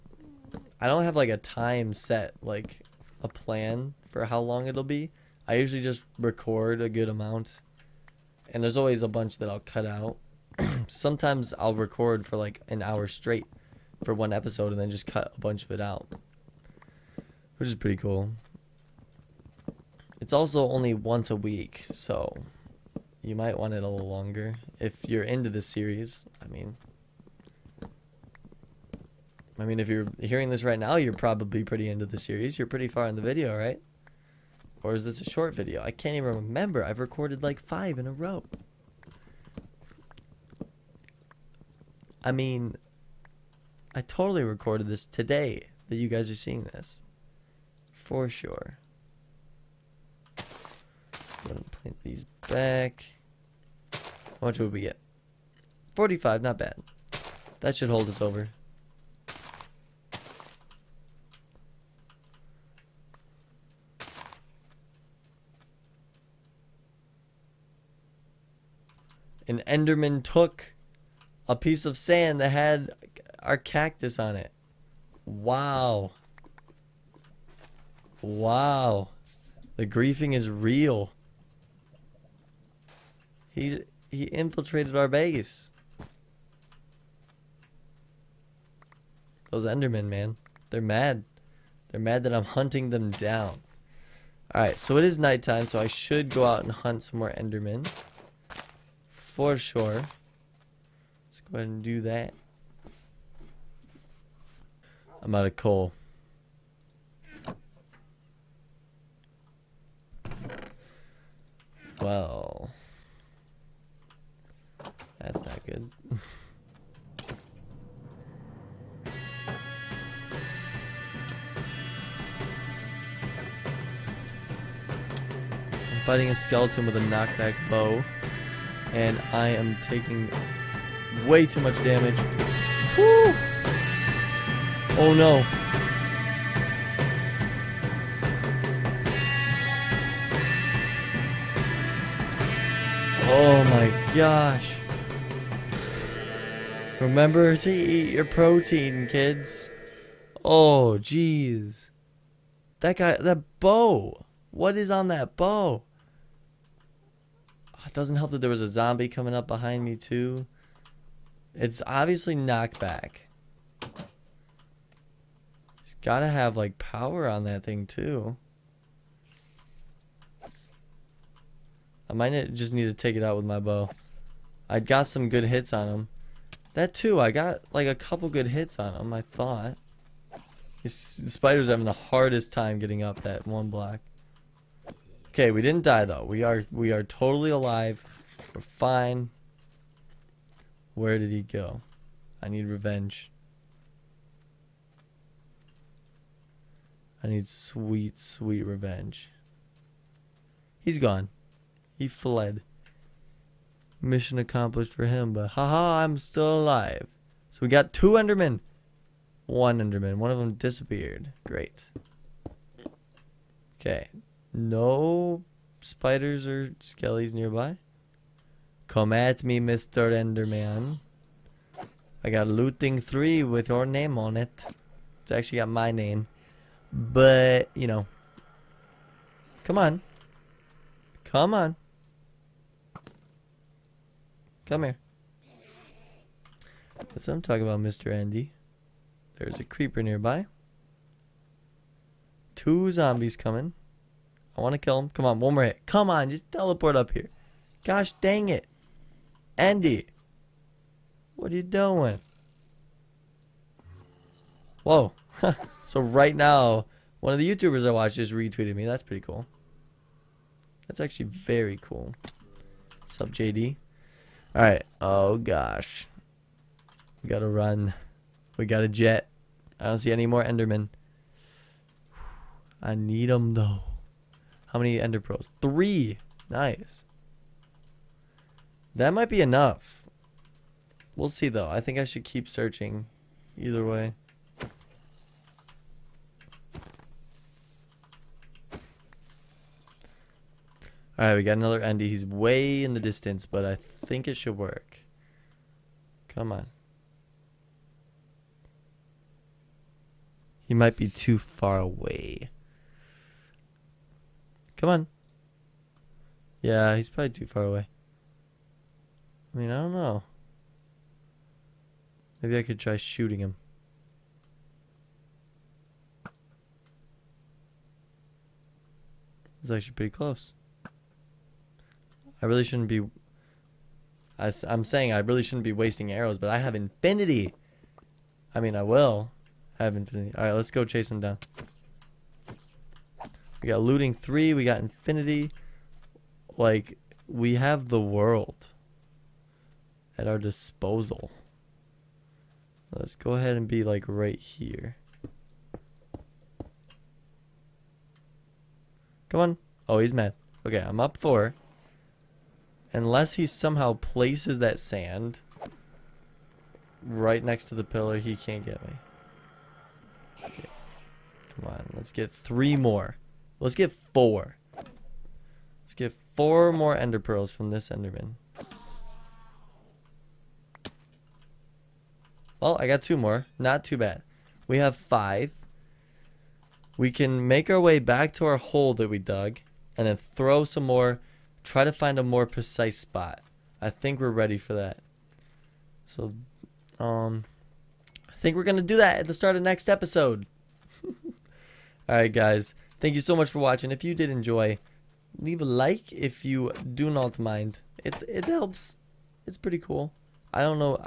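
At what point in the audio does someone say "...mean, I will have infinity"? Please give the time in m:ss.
5:28.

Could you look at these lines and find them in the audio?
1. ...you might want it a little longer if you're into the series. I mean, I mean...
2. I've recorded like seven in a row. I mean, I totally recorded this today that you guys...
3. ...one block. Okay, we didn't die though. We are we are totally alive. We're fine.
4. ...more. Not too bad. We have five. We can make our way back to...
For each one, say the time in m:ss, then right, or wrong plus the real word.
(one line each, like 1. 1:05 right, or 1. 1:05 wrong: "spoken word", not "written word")
1. 0:23 right
2. 0:36 wrong: "five", not "seven"
3. 3:03 right
4. 6:13 right.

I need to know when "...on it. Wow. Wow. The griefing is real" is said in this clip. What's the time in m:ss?
1:14.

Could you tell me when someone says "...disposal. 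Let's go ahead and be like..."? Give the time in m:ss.
5:40.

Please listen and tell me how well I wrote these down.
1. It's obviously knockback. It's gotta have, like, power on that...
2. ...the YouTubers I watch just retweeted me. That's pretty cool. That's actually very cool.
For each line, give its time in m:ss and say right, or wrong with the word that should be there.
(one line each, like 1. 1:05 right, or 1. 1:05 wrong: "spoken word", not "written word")
1. 2:41 right
2. 4:17 right.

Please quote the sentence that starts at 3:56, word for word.
That's what I'm talking about, Mr.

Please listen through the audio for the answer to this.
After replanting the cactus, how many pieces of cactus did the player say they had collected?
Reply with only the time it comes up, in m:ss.
0:55.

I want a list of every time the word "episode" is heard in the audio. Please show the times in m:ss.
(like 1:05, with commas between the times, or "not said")
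0:14, 6:29.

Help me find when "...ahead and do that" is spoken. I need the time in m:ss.
1:41.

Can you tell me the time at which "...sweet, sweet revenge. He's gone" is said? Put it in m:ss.
3:17.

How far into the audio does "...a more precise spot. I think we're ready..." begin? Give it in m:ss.
6:22.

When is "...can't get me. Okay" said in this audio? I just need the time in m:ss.
5:58.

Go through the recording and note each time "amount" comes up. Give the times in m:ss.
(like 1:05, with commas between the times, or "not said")
0:07.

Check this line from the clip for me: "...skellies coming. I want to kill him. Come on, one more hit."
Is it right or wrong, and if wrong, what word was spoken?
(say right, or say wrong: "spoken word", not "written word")
wrong: "zombies", not "skellies".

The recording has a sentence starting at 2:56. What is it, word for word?
That too, I got like a couple good hits on him, I thought.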